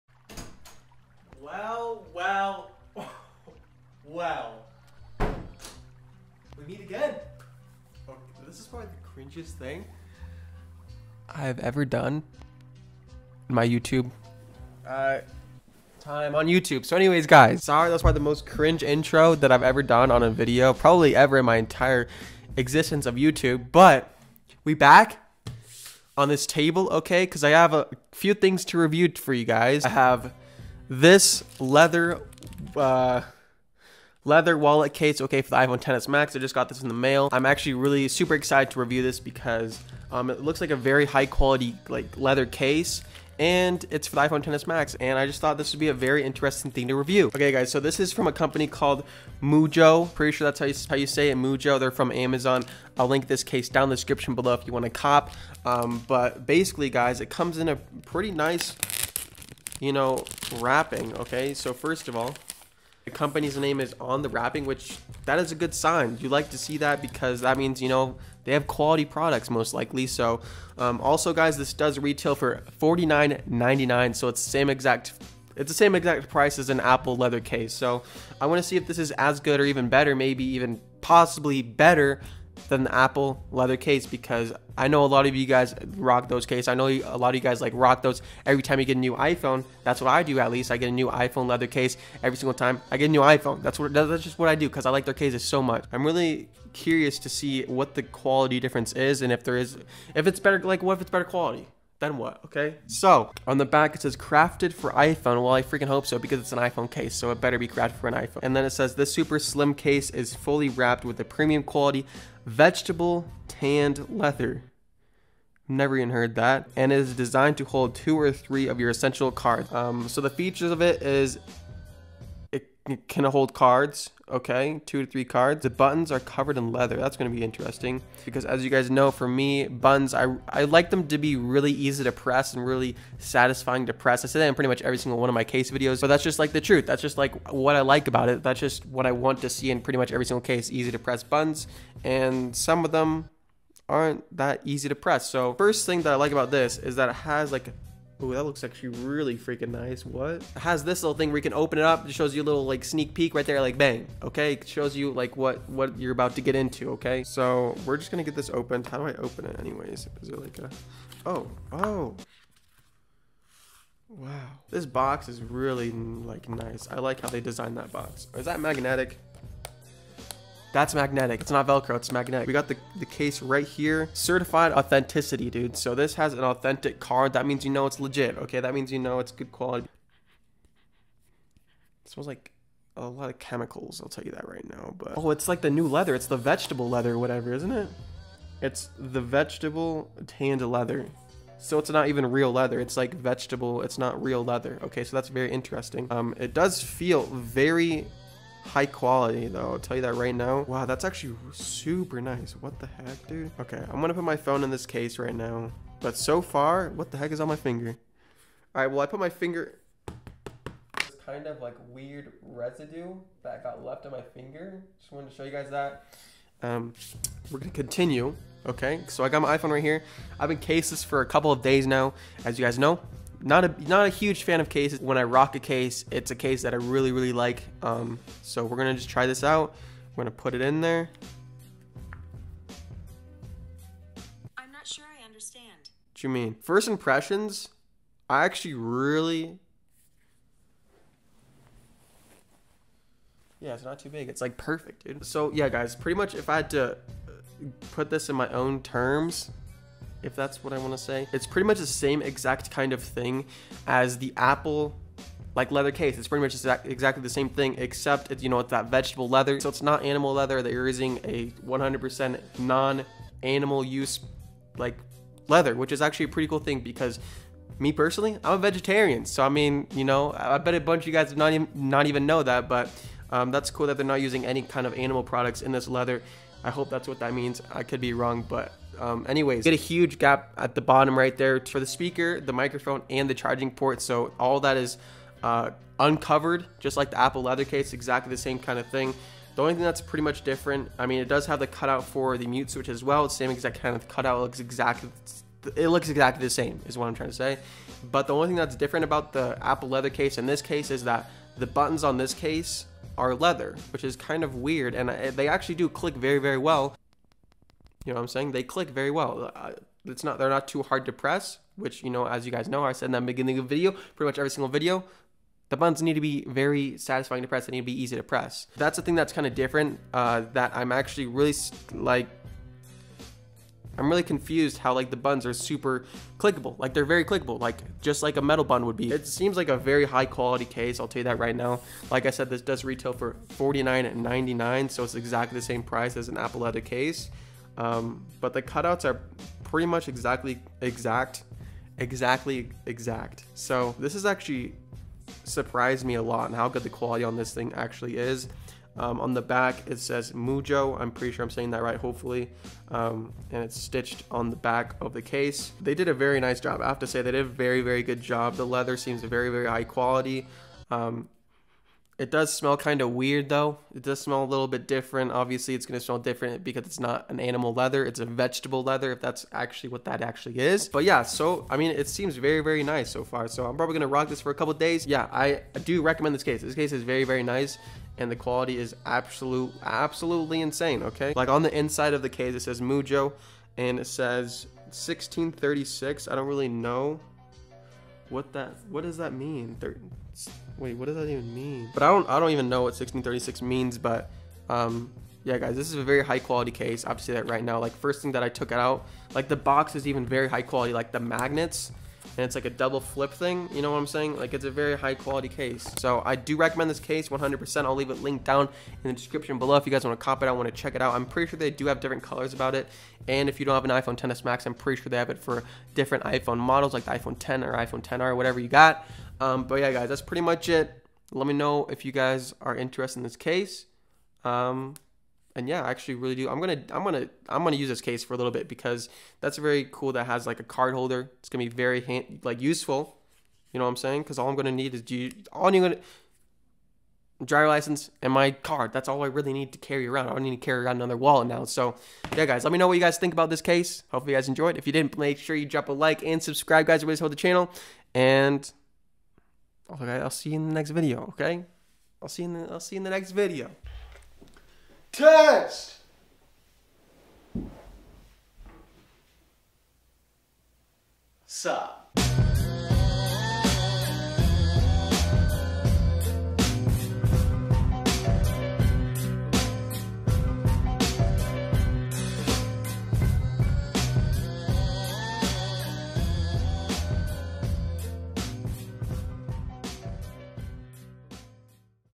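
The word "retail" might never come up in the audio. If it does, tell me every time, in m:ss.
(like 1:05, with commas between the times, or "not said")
1:11, 5:32.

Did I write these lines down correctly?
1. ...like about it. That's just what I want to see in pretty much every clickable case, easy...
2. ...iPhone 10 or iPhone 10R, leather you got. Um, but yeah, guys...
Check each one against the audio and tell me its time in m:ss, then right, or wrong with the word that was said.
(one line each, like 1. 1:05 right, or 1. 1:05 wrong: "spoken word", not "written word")
1. 2:17 wrong: "single", not "clickable"
2. 6:57 wrong: "whatever", not "leather".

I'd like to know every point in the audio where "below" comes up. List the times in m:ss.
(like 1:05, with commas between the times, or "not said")
0:54, 6:49.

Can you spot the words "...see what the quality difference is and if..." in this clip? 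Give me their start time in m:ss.
1:37.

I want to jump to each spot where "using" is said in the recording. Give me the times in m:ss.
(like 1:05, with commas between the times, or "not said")
4:20, 4:34.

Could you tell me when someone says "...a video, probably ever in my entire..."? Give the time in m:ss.
0:20.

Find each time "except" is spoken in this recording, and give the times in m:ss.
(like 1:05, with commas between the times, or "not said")
4:17.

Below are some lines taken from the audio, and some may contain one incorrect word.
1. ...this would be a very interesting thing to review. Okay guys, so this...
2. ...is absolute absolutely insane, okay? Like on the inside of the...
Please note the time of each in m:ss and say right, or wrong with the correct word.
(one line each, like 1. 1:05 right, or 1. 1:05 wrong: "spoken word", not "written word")
1. 0:45 right
2. 6:18 right.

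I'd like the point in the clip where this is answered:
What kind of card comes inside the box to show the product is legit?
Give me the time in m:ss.
2:55.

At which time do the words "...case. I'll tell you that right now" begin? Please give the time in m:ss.
5:30.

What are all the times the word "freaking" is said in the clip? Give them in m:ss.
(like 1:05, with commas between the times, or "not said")
1:45, 2:29.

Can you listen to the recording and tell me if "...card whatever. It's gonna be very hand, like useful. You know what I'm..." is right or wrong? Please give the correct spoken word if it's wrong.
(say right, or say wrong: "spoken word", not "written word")
wrong: "holder", not "whatever".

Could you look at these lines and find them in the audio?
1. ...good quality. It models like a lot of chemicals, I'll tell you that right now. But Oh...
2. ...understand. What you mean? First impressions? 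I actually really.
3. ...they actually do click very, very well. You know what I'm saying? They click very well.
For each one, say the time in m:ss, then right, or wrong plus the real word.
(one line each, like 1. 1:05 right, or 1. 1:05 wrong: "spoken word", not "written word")
1. 2:59 wrong: "smells", not "models"
2. 3:55 right
3. 5:05 right.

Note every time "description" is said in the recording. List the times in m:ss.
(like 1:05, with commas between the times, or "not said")
0:53, 6:49.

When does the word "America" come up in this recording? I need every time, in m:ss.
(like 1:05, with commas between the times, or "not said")
not said.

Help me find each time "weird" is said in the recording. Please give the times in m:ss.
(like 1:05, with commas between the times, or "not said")
3:31, 5:04, 6:03.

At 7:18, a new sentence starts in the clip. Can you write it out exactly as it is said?
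That's all I really need to carry around.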